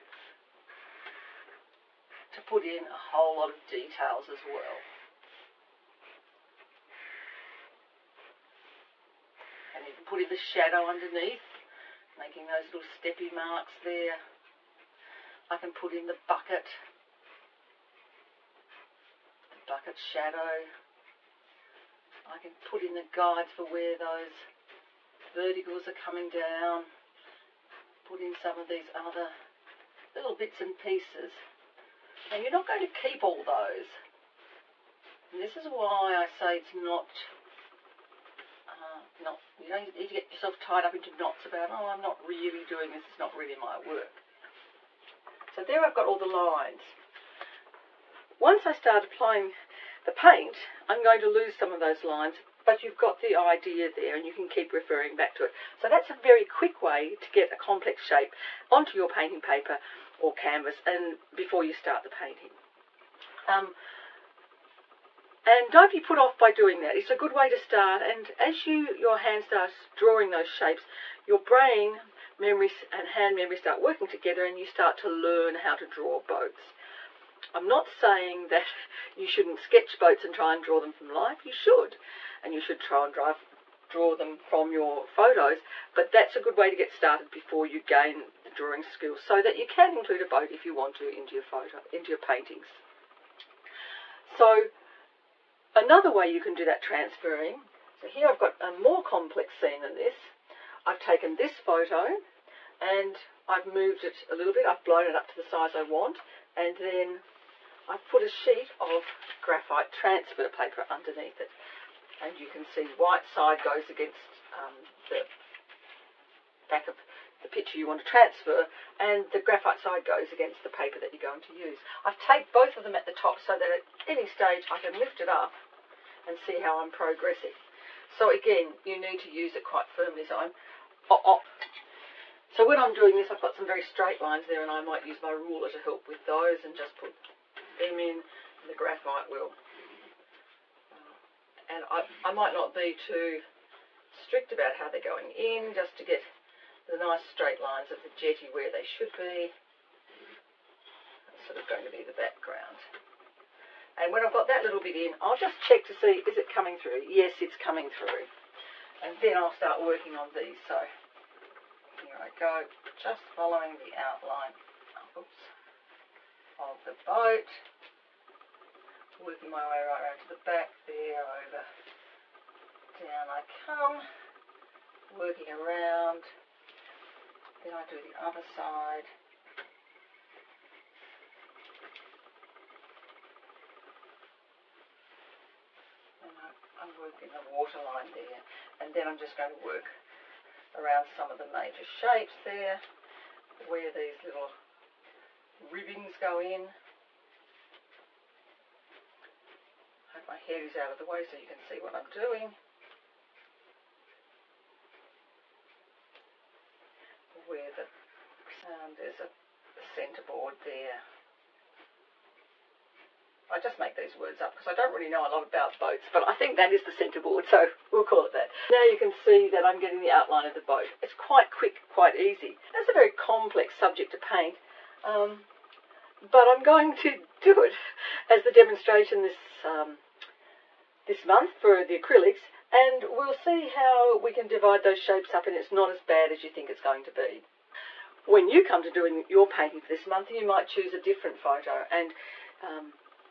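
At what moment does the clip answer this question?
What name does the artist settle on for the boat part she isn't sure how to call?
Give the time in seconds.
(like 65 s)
216 s.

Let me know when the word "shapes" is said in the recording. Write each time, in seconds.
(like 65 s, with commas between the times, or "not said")
58 s, 70 s, 191 s, 234 s.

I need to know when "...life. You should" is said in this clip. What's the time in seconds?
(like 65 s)
81 s.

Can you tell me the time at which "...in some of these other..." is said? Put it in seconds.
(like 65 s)
28 s.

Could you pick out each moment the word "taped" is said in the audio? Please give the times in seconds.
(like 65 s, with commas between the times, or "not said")
122 s.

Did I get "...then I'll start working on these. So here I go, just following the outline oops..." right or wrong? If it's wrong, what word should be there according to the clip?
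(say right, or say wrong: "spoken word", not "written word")
right.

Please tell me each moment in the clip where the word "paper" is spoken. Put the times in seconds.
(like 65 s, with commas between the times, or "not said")
59 s, 110 s, 120 s.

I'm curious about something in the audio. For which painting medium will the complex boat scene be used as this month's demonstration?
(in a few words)
Acrylics.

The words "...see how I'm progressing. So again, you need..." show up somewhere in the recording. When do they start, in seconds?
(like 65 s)
126 s.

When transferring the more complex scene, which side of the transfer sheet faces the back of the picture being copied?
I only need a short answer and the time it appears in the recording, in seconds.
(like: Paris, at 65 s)
White side, at 112 s.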